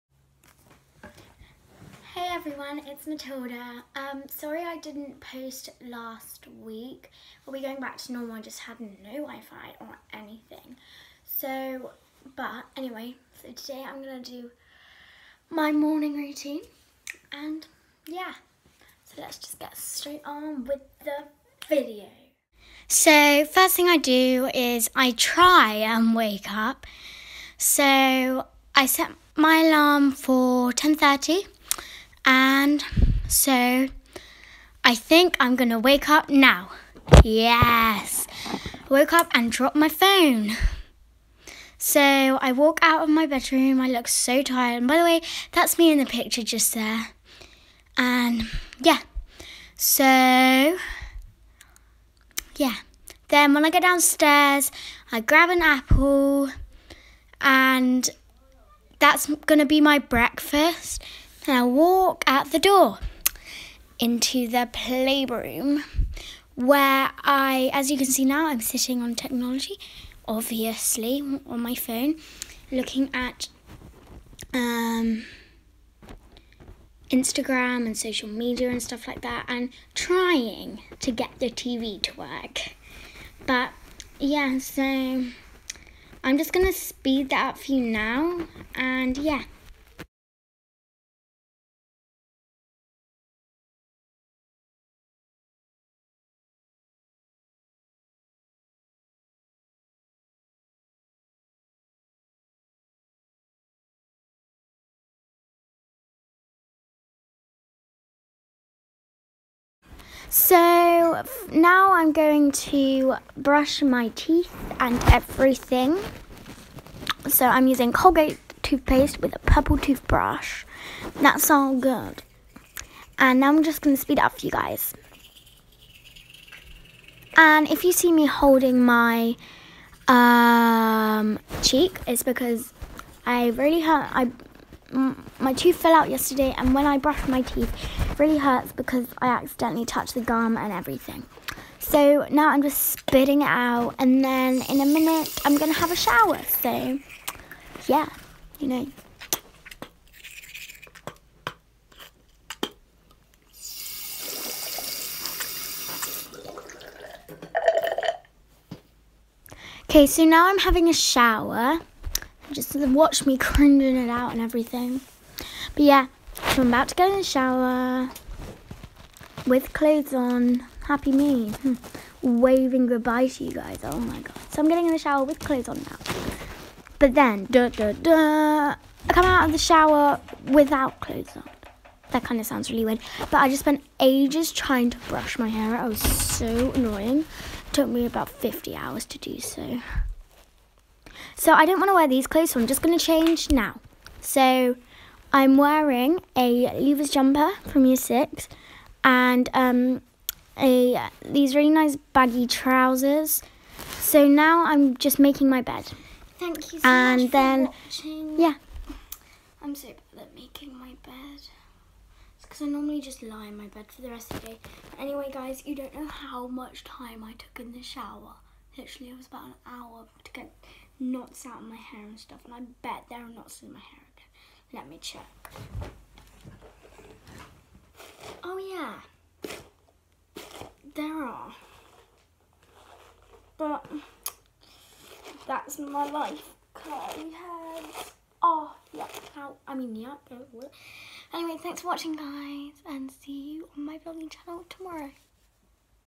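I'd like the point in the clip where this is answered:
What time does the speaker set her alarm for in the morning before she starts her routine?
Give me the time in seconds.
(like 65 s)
30 s.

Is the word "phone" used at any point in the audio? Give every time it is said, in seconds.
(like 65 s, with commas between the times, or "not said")
39 s, 71 s.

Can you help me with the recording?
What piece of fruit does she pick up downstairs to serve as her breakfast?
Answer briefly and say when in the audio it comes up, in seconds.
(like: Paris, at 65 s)
An apple, at 55 s.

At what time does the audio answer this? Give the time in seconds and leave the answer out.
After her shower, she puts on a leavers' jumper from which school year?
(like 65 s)
197 s.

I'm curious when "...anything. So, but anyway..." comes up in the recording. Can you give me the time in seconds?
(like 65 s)
10 s.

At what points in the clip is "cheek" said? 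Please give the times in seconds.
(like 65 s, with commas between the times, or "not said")
131 s.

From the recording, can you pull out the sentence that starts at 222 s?
And I bet there are knots in my hair again.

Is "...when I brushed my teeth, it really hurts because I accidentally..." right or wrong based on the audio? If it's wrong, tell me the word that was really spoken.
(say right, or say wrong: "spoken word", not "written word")
right.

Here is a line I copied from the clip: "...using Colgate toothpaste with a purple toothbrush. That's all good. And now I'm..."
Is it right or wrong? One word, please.
right.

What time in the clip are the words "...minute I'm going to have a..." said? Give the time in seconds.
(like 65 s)
144 s.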